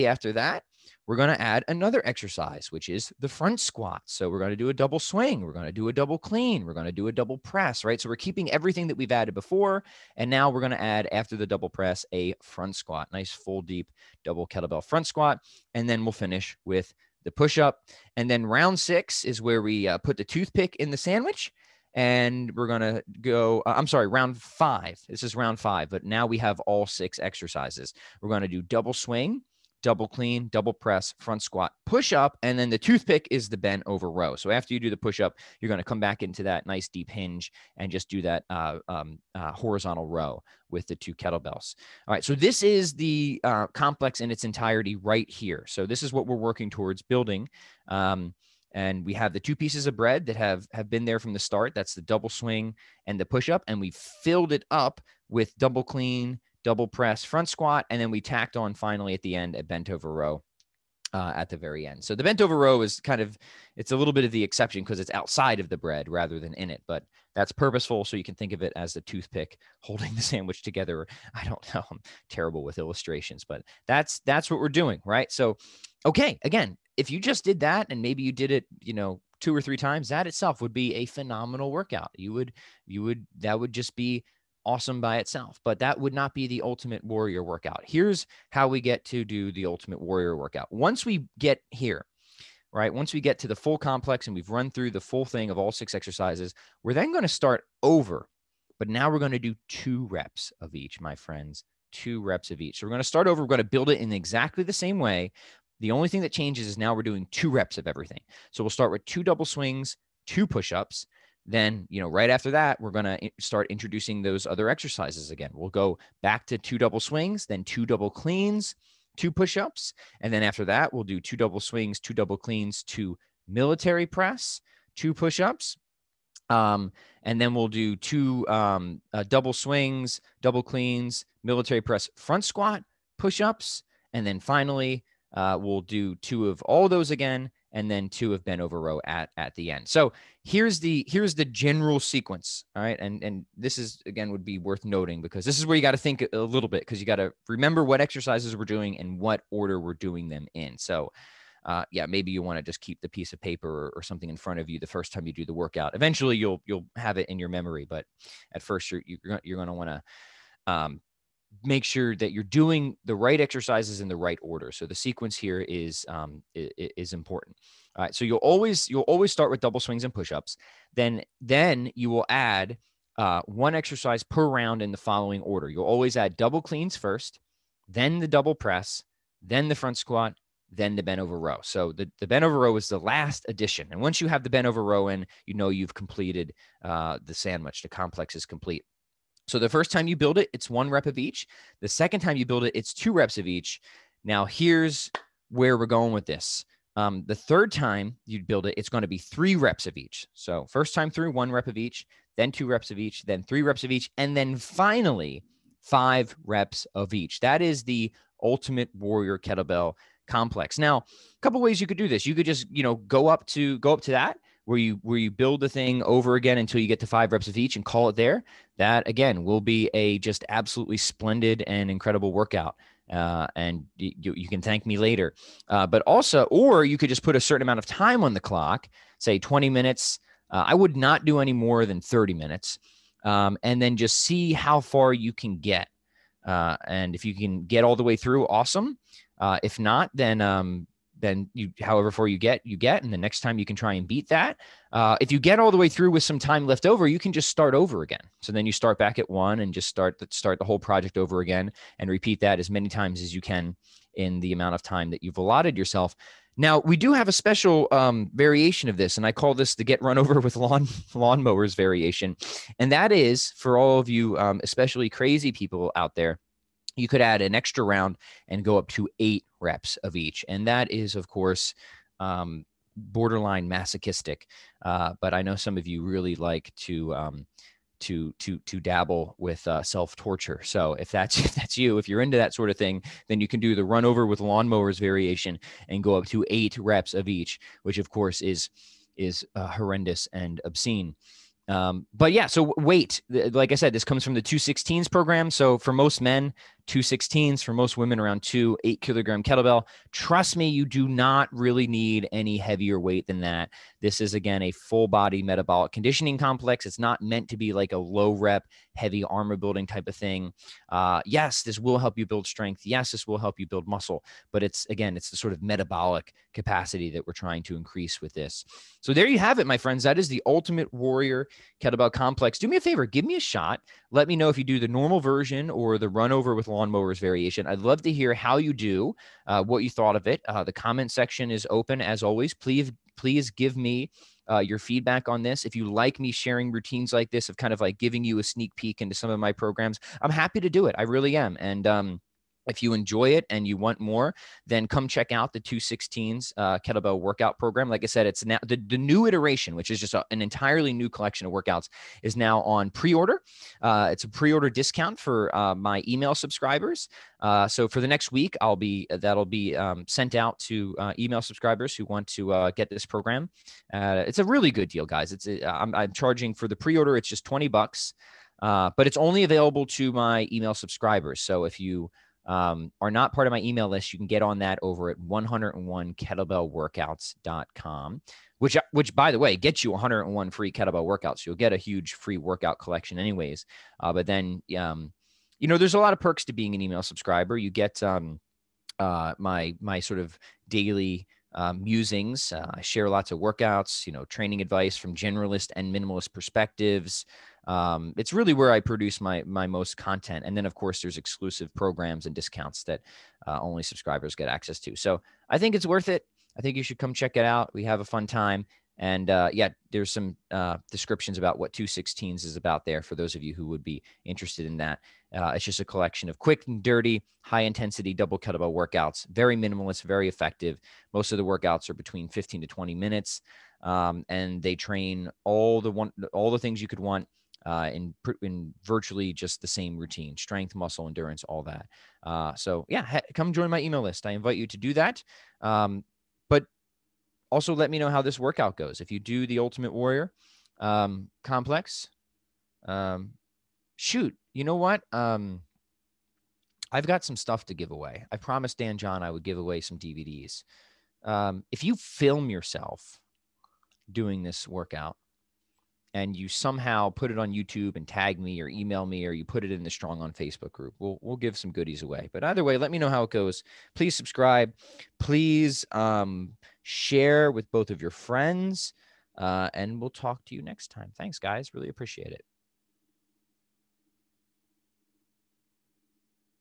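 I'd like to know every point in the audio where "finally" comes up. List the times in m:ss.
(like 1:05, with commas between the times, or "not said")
0:58, 2:14, 3:24.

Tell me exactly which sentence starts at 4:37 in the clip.
Um, to to to dabble with uh, self torture.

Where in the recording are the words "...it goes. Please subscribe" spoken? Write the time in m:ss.
7:43.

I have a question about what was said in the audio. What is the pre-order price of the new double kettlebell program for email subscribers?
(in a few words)
20 bucks.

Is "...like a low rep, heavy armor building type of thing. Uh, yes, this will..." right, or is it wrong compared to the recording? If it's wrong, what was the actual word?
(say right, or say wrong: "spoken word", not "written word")
right.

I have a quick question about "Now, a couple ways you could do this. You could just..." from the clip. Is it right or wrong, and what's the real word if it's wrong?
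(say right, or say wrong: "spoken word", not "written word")
right.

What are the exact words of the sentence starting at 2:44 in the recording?
So the sequence here is um, is important.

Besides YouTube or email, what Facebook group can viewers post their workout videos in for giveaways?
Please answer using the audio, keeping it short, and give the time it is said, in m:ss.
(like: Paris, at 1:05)
StrongOn, at 7:39.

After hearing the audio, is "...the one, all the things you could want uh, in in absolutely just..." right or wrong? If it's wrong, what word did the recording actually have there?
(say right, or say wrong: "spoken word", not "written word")
wrong: "virtually", not "absolutely".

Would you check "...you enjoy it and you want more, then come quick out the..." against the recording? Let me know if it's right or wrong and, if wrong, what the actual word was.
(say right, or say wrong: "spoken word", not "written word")
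wrong: "check", not "quick".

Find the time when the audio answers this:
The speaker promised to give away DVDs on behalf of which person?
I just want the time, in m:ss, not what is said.
7:28.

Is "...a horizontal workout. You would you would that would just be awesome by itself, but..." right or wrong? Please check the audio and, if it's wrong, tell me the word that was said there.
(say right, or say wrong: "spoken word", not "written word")
wrong: "phenomenal", not "horizontal".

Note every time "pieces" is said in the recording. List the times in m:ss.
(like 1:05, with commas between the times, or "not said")
0:49, 2:33.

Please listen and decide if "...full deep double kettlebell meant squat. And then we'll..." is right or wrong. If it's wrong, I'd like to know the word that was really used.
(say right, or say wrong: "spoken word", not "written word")
wrong: "front", not "meant".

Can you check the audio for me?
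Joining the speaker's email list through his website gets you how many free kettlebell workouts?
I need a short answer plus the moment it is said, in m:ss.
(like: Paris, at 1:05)
101, at 6:19.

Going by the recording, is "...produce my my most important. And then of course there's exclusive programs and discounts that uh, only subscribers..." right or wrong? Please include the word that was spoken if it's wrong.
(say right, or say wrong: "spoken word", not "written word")
wrong: "content", not "important".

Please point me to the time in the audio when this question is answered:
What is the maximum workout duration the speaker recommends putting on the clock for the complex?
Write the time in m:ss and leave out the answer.
3:51.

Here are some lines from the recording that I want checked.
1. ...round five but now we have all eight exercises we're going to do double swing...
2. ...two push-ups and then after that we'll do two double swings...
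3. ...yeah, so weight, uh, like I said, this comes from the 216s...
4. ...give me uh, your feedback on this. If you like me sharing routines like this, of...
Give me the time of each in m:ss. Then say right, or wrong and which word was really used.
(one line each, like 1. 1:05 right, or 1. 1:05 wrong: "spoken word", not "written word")
1. 0:25 wrong: "six", not "eight"
2. 1:59 right
3. 4:52 right
4. 5:33 right.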